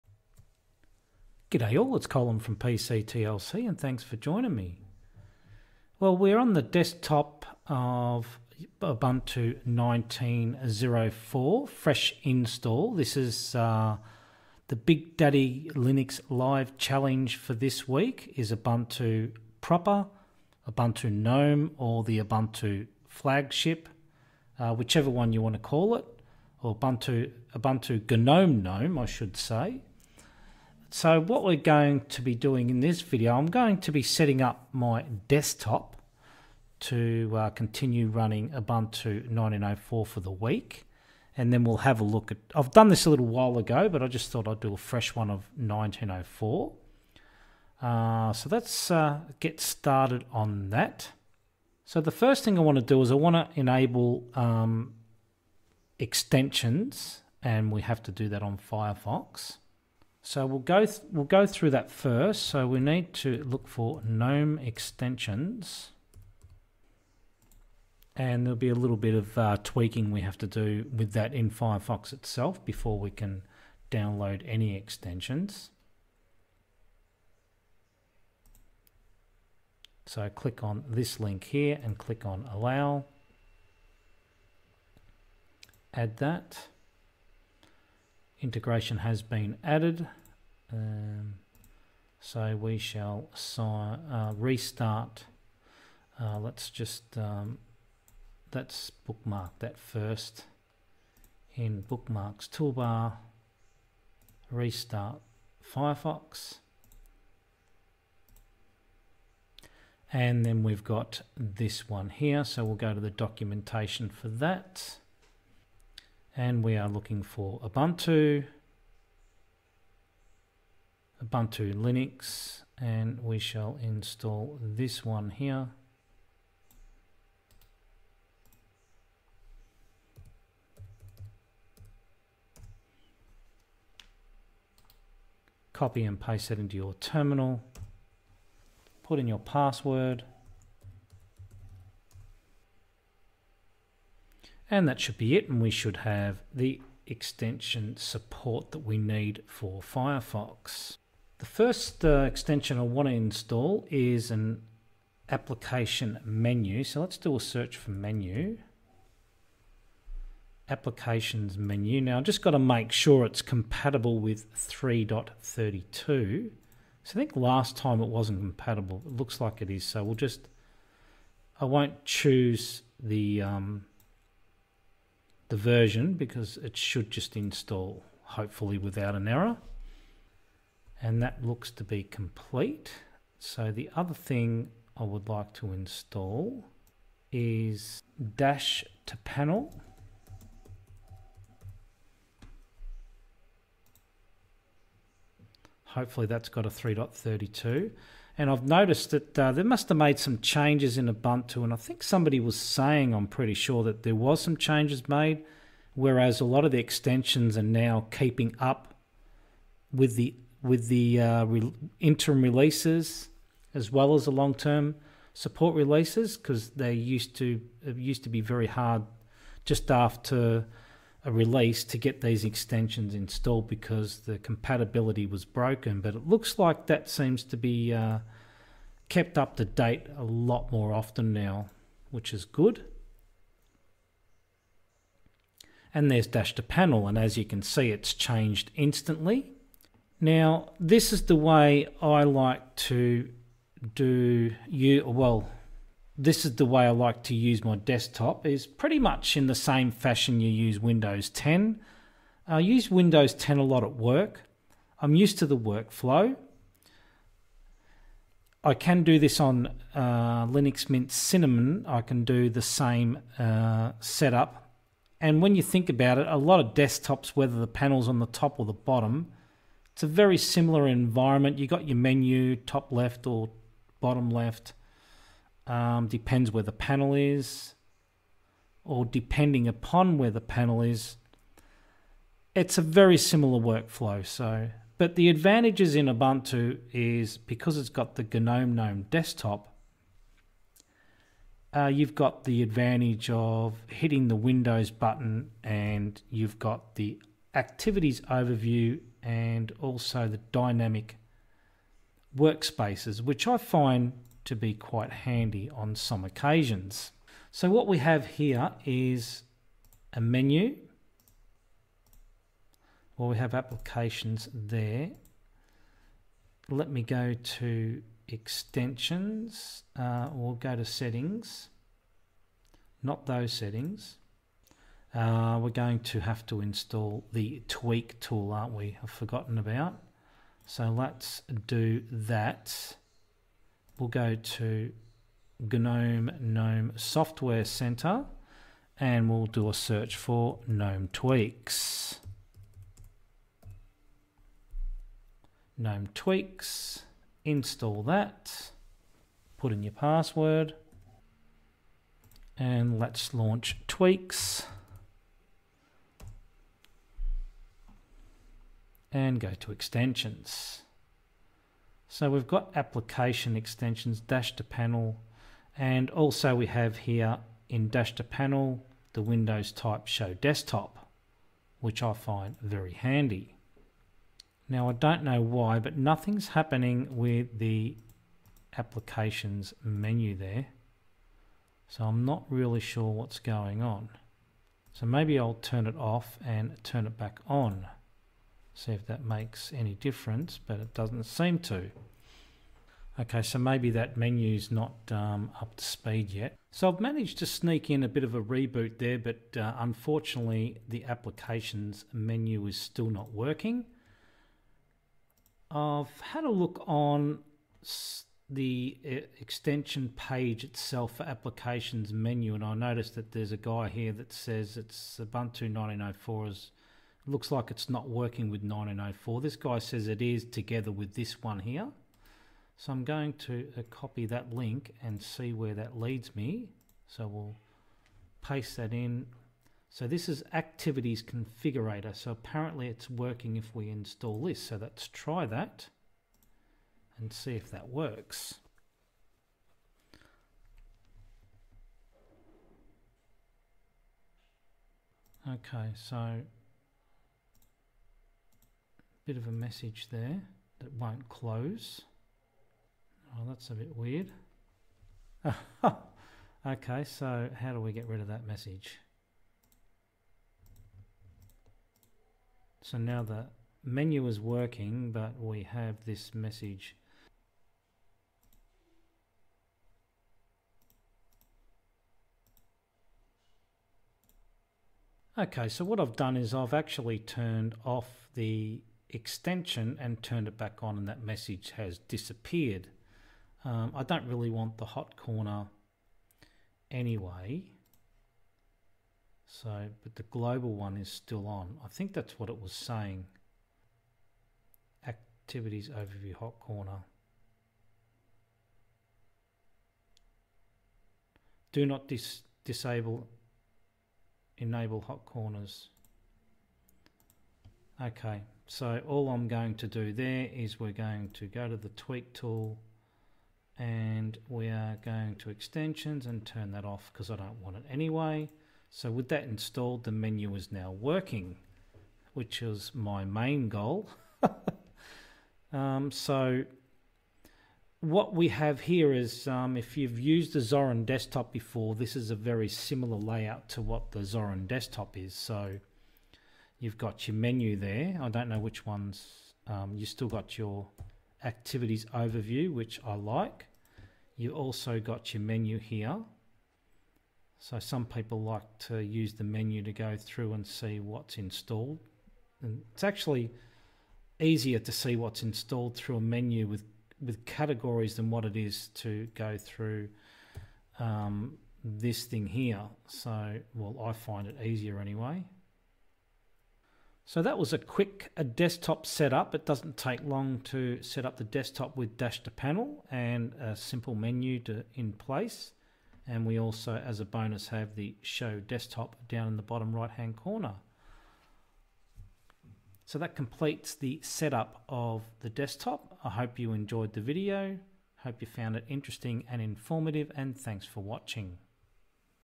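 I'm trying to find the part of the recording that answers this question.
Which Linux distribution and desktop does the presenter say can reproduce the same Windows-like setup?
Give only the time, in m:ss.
4:20.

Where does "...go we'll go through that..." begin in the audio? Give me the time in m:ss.
1:00.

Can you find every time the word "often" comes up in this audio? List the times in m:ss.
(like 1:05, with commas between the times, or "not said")
3:50.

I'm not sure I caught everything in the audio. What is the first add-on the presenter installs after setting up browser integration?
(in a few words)
Application menu.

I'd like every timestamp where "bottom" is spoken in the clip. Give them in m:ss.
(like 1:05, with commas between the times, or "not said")
4:28, 4:33, 9:39.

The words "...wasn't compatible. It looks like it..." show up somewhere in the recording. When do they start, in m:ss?
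2:48.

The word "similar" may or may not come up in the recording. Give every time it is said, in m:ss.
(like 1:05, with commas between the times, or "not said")
4:30, 4:43, 8:52.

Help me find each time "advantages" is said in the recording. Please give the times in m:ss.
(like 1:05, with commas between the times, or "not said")
4:45, 4:52.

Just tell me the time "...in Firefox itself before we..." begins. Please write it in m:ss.
1:11.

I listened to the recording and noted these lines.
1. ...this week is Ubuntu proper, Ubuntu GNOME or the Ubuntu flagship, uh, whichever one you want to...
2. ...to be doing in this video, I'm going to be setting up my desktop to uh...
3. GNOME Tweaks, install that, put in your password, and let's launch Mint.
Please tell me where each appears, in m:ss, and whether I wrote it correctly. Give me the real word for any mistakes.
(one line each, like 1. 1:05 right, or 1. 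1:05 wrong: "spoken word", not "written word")
1. 0:17 right
2. 0:32 right
3. 5:45 wrong: "Tweaks", not "Mint".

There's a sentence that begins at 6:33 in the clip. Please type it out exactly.
Okay, so maybe that menu's not um, up to speed yet.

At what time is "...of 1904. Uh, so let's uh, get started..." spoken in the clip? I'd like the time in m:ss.
0:45.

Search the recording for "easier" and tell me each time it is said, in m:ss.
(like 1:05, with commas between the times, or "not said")
9:14, 9:24.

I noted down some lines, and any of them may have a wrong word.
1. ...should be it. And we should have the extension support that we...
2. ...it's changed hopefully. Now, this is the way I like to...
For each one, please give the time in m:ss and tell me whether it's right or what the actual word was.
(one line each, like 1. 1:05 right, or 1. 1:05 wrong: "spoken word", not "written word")
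1. 2:25 right
2. 3:57 wrong: "instantly", not "hopefully".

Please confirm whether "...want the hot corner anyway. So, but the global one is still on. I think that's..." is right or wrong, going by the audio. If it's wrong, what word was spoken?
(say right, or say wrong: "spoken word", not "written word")
right.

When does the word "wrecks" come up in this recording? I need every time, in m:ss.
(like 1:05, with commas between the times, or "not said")
not said.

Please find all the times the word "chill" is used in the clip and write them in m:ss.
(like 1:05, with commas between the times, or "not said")
not said.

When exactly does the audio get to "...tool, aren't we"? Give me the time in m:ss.
5:28.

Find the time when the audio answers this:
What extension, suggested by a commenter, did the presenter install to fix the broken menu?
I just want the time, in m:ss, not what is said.
7:10.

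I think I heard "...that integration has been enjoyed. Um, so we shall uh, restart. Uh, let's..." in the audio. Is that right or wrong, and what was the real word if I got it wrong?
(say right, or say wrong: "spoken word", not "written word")
wrong: "added", not "enjoyed".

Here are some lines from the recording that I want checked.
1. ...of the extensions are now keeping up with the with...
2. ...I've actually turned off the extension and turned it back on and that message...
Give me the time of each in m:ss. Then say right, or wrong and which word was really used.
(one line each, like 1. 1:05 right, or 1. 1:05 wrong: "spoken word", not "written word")
1. 3:26 right
2. 7:56 right.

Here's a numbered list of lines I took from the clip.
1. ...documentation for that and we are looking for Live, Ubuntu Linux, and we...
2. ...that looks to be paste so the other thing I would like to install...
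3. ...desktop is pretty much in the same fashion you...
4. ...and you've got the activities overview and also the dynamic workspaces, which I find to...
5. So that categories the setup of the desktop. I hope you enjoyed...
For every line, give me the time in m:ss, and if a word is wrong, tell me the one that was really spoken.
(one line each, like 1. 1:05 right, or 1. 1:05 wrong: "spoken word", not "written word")
1. 1:53 wrong: "Ubuntu", not "Live"
2. 3:01 wrong: "complete", not "paste"
3. 4:07 right
4. 4:55 right
5. 9:43 wrong: "completes", not "categories".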